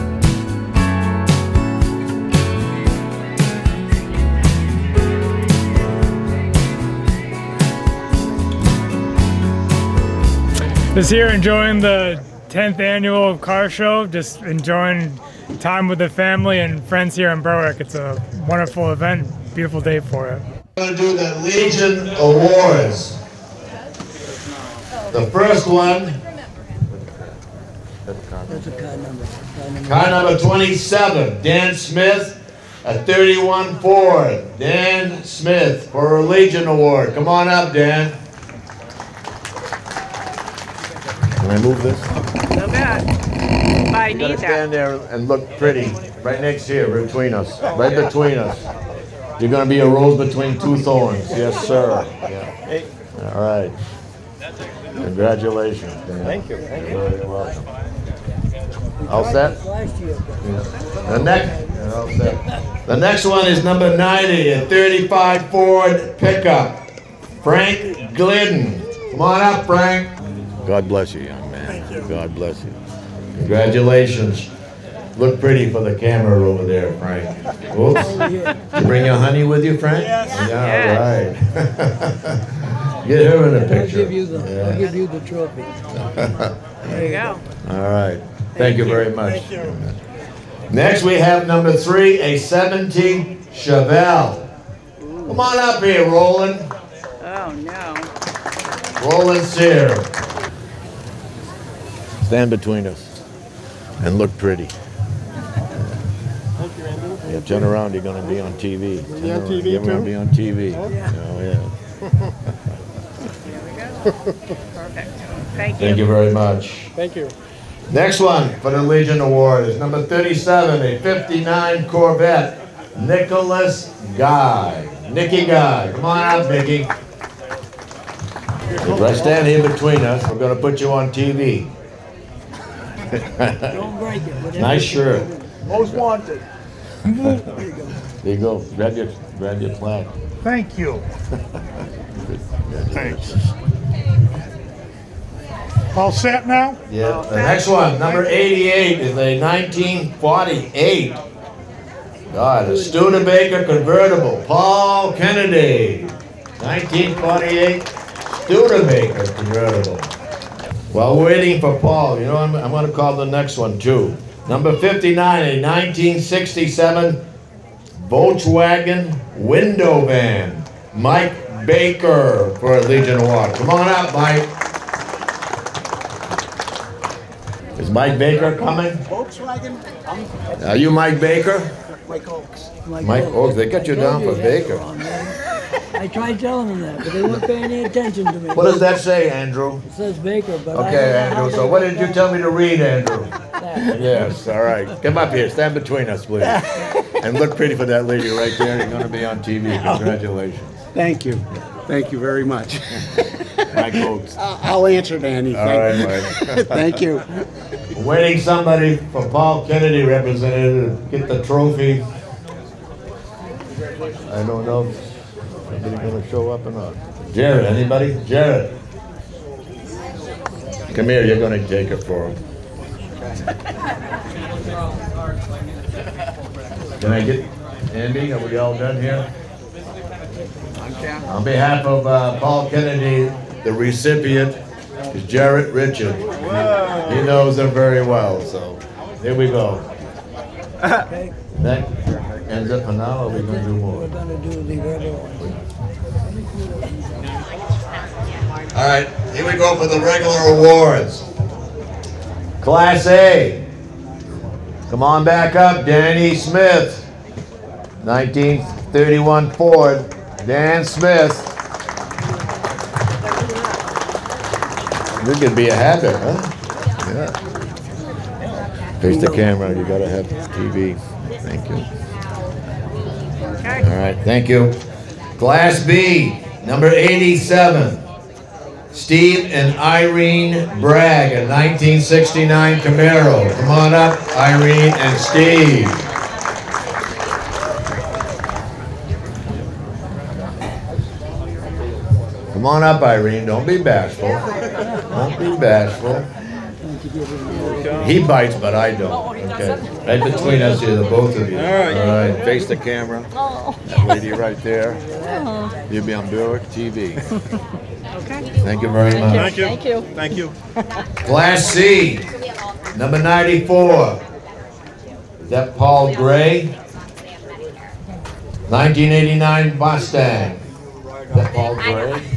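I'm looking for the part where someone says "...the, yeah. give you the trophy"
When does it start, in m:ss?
1:24.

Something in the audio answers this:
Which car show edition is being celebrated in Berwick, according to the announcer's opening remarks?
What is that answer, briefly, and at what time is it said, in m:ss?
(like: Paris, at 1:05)
10th annual, at 0:12.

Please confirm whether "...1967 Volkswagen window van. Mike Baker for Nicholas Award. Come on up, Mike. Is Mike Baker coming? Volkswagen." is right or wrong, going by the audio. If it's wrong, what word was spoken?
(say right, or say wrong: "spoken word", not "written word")
wrong: "Legion", not "Nicholas".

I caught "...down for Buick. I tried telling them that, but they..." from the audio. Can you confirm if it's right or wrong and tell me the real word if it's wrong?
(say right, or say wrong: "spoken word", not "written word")
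wrong: "Baker", not "Buick".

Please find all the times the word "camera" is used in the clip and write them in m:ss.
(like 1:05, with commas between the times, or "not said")
1:15, 4:29, 5:02.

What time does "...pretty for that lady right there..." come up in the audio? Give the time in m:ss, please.
3:17.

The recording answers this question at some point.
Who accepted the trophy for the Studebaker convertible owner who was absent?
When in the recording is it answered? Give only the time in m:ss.
3:55.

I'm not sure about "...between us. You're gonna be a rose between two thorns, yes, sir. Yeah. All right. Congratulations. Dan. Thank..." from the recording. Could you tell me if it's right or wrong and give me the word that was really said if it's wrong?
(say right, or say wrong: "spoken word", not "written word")
right.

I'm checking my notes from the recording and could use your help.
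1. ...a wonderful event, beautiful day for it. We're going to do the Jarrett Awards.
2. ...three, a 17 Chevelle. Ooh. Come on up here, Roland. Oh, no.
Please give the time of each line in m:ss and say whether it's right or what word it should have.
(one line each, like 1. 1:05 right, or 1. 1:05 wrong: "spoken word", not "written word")
1. 0:17 wrong: "Legion", not "Jarrett"
2. 1:31 right.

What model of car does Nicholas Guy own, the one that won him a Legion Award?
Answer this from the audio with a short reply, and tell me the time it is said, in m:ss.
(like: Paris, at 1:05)
59 Corvette, at 2:00.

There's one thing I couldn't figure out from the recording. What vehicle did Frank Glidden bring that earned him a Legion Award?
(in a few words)
35 Ford pickup.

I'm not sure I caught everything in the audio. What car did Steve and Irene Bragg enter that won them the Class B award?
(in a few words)
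1969 Camaro.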